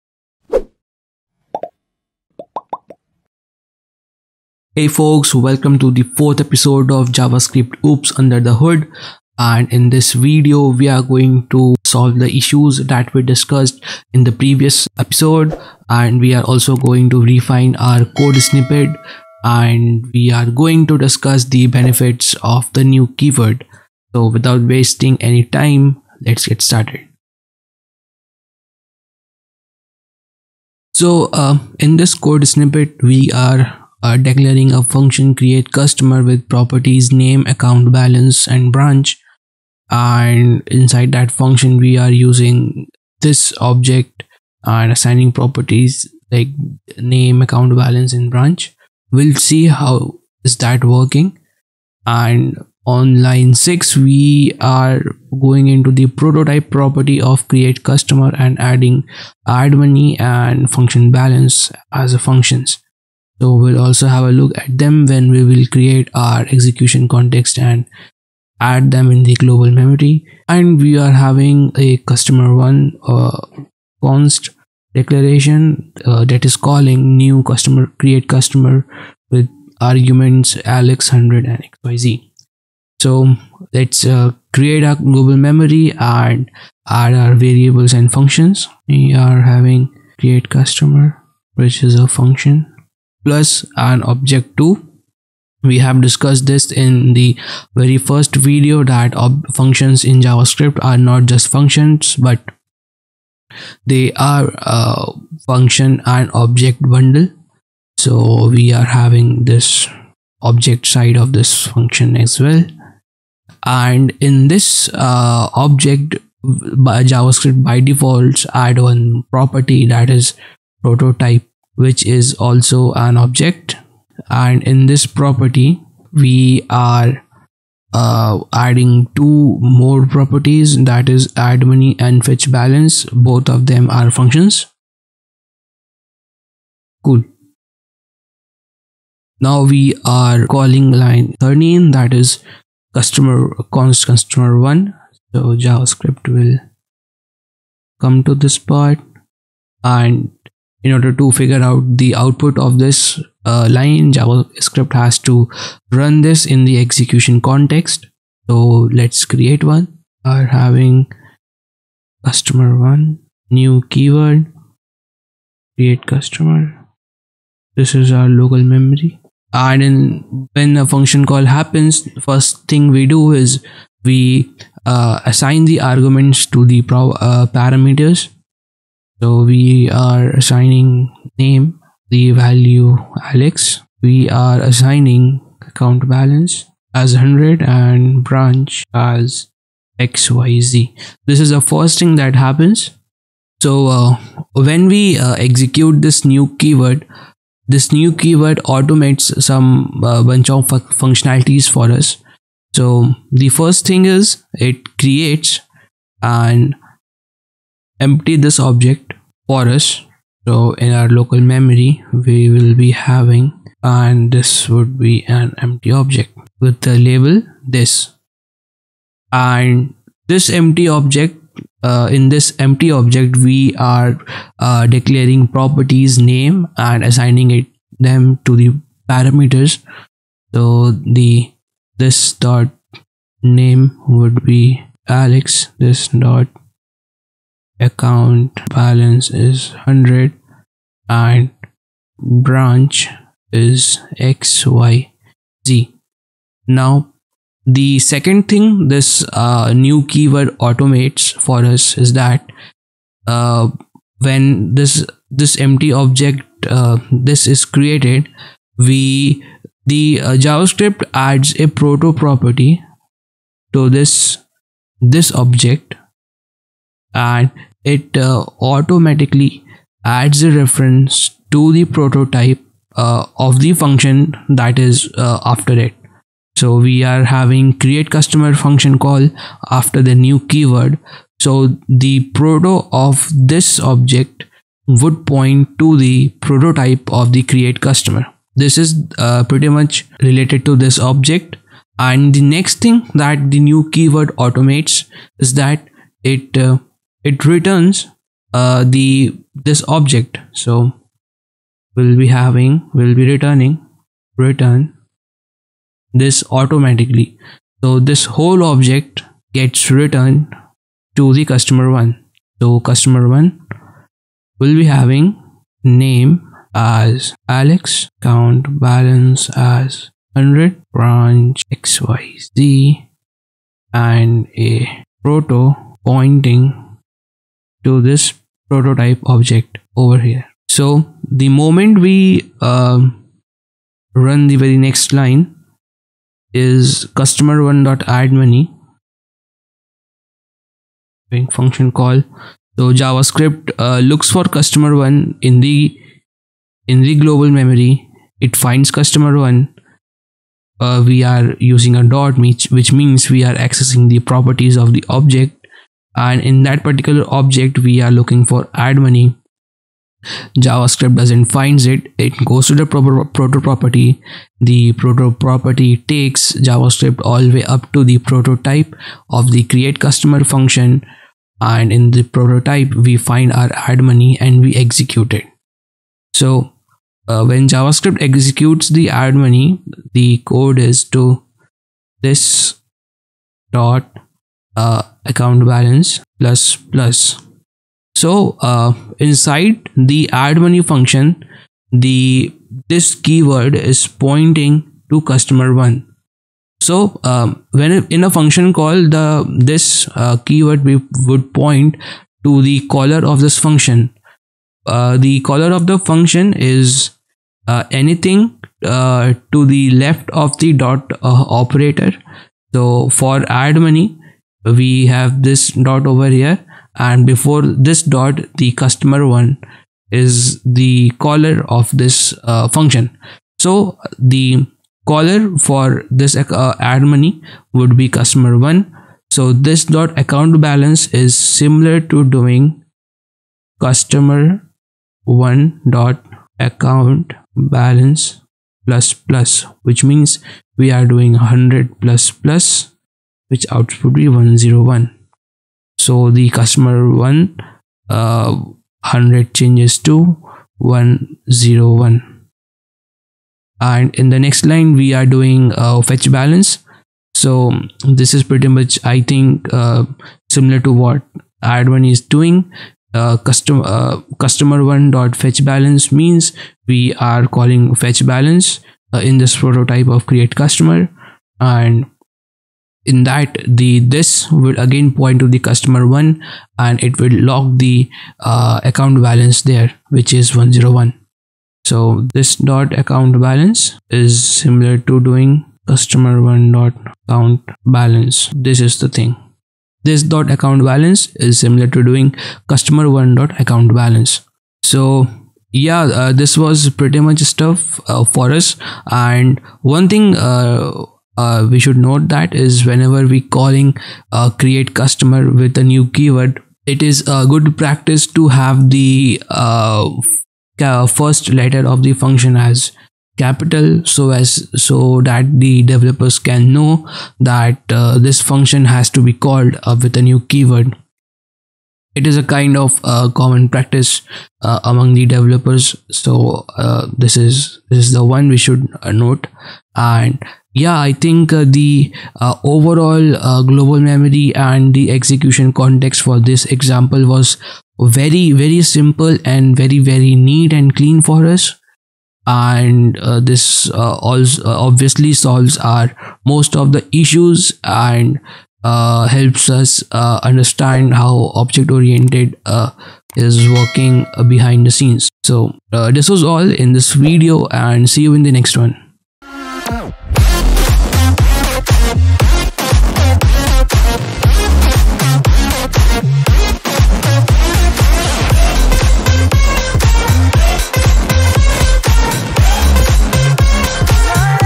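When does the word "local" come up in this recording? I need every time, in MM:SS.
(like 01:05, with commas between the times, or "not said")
02:48, 03:31.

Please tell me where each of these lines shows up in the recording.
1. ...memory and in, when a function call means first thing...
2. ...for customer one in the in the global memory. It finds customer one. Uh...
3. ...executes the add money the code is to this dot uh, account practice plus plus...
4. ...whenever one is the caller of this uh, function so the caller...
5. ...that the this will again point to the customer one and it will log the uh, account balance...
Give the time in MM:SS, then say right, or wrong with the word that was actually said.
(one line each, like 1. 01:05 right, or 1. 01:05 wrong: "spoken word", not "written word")
1. 02:48 wrong: "happens", not "means"
2. 05:44 right
3. 06:18 wrong: "balance", not "practice"
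4. 06:58 wrong: "customer", not "whenever"
5. 07:53 right.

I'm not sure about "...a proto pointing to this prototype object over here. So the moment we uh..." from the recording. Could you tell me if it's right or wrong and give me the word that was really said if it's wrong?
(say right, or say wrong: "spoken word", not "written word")
right.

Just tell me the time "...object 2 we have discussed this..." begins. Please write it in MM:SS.
01:34.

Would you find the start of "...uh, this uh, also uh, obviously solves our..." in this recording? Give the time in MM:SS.
09:03.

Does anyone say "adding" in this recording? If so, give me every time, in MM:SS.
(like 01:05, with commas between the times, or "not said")
00:58, 02:08.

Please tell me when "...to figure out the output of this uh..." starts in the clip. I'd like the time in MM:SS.
02:31.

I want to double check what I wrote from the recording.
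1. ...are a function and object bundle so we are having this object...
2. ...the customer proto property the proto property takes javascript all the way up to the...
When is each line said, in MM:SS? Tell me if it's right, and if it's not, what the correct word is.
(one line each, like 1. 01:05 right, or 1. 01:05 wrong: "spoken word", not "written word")
1. 01:44 right
2. 06:02 wrong: "proper", not "customer".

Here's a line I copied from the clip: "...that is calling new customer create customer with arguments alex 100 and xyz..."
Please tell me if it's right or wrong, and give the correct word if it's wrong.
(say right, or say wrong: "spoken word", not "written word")
right.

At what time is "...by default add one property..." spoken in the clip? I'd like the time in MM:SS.
01:57.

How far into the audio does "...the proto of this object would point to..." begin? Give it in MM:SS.
04:41.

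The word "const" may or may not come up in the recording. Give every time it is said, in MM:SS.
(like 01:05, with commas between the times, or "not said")
01:14, 02:23.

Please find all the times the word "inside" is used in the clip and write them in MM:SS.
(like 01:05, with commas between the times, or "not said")
00:40, 06:29.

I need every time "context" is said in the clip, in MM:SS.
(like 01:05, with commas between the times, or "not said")
01:07, 02:37, 08:55.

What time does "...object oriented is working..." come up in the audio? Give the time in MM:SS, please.
09:11.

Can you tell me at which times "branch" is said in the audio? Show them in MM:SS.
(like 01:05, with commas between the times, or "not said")
00:38, 00:48, 03:08, 04:02, 05:20.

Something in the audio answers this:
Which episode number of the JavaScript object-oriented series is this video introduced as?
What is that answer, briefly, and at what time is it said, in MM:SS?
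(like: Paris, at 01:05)
fourth, at 00:06.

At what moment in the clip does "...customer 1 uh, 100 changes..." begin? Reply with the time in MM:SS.
07:26.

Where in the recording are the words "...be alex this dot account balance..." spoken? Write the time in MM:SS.
03:54.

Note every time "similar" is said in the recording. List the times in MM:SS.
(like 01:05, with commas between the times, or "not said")
07:11, 07:40, 08:04, 08:11.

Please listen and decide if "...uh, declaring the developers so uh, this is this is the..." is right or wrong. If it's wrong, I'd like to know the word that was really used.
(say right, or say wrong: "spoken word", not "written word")
wrong: "among", not "declaring".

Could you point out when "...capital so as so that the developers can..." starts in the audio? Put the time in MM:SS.
08:33.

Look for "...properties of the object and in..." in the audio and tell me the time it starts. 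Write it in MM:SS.
05:54.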